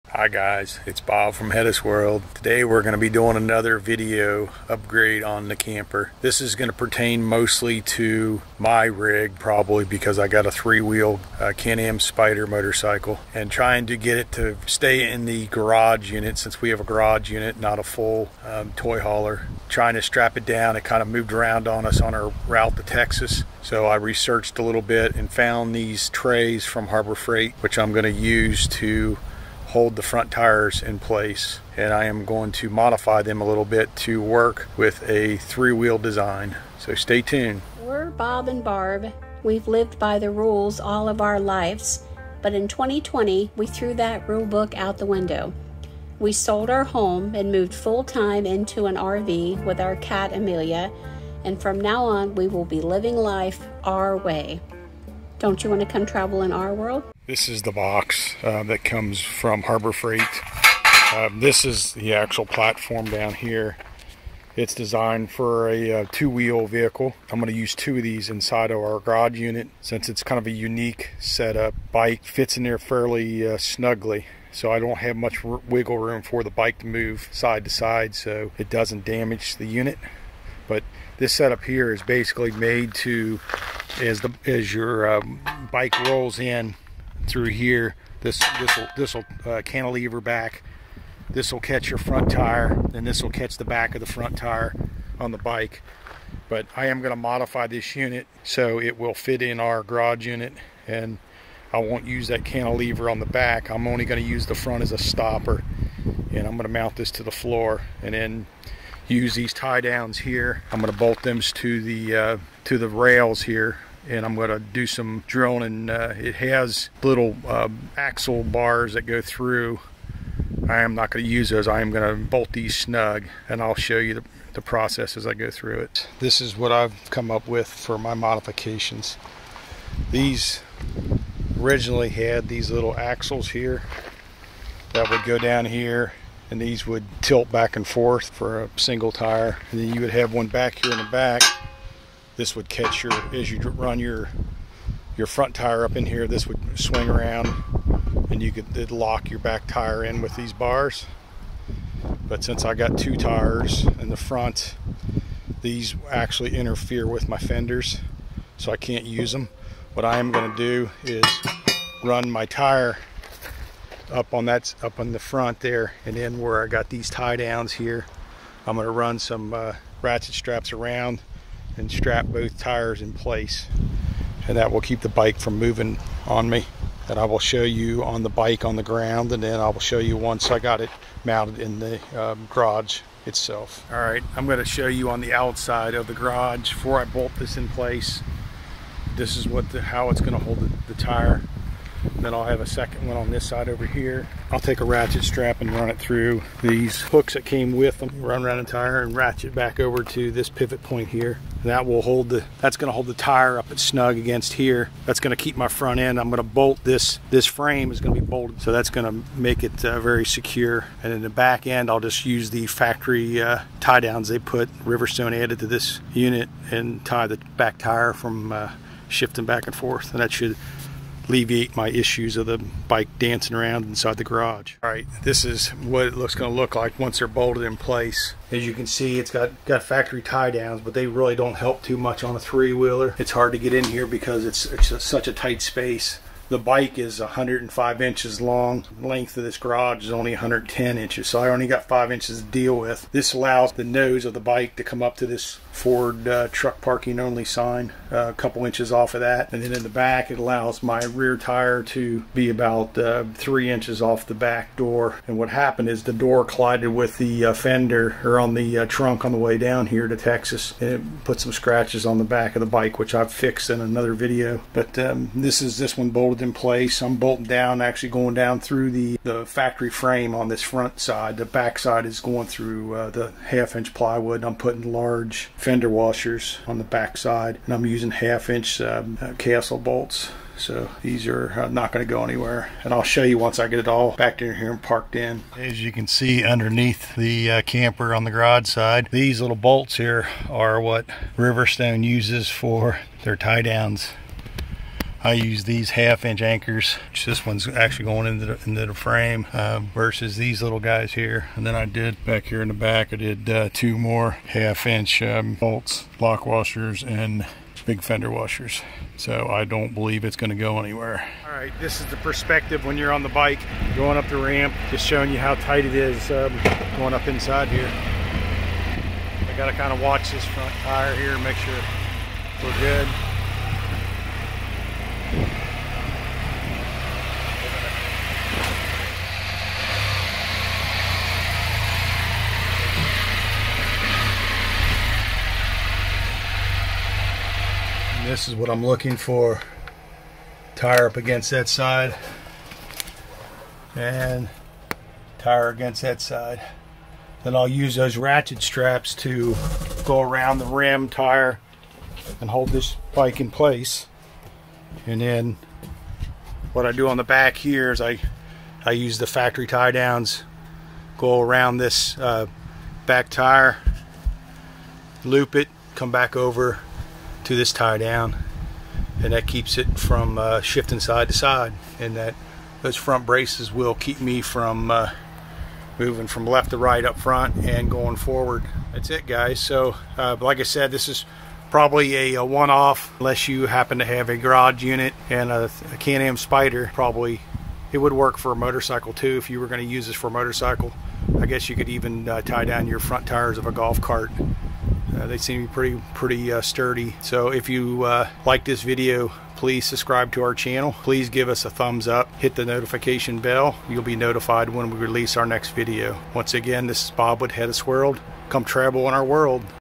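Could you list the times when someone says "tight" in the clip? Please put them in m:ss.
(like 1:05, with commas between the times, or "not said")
3:55, 5:15.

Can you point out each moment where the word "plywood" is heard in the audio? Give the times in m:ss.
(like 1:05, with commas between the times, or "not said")
4:33.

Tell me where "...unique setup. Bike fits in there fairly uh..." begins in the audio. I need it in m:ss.
1:10.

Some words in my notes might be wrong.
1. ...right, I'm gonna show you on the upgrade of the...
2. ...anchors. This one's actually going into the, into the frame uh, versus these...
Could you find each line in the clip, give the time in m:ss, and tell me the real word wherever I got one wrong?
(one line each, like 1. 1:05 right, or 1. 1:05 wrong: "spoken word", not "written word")
1. 3:03 wrong: "outside", not "upgrade"
2. 4:56 right.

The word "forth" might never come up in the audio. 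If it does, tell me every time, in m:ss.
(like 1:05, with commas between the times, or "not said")
2:17, 3:39.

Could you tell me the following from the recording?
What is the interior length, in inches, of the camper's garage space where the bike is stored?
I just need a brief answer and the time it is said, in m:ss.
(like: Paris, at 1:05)
110 inches, at 4:00.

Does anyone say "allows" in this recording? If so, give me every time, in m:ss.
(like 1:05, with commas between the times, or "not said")
4:03, 4:10.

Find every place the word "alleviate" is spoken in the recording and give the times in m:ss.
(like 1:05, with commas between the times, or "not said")
3:41.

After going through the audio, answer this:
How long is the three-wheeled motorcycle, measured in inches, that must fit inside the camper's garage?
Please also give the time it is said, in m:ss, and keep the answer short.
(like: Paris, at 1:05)
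105 inches, at 3:57.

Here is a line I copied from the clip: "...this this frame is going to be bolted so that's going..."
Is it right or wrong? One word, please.
right.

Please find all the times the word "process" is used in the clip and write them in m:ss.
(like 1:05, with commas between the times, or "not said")
2:04.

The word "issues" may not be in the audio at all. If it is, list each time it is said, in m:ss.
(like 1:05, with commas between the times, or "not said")
3:41.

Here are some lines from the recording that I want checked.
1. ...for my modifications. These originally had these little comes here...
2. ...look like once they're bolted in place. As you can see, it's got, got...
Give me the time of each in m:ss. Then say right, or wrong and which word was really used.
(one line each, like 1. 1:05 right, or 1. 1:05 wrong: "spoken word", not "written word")
1. 2:07 wrong: "axles", not "comes"
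2. 3:46 right.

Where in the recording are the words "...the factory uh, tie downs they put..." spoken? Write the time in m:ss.
3:32.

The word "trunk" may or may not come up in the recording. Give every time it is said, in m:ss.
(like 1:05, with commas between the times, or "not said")
4:18.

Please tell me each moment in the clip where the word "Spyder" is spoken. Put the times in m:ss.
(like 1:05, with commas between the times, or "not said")
0:11, 6:26.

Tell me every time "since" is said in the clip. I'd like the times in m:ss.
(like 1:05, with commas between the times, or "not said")
0:16, 1:09, 2:32.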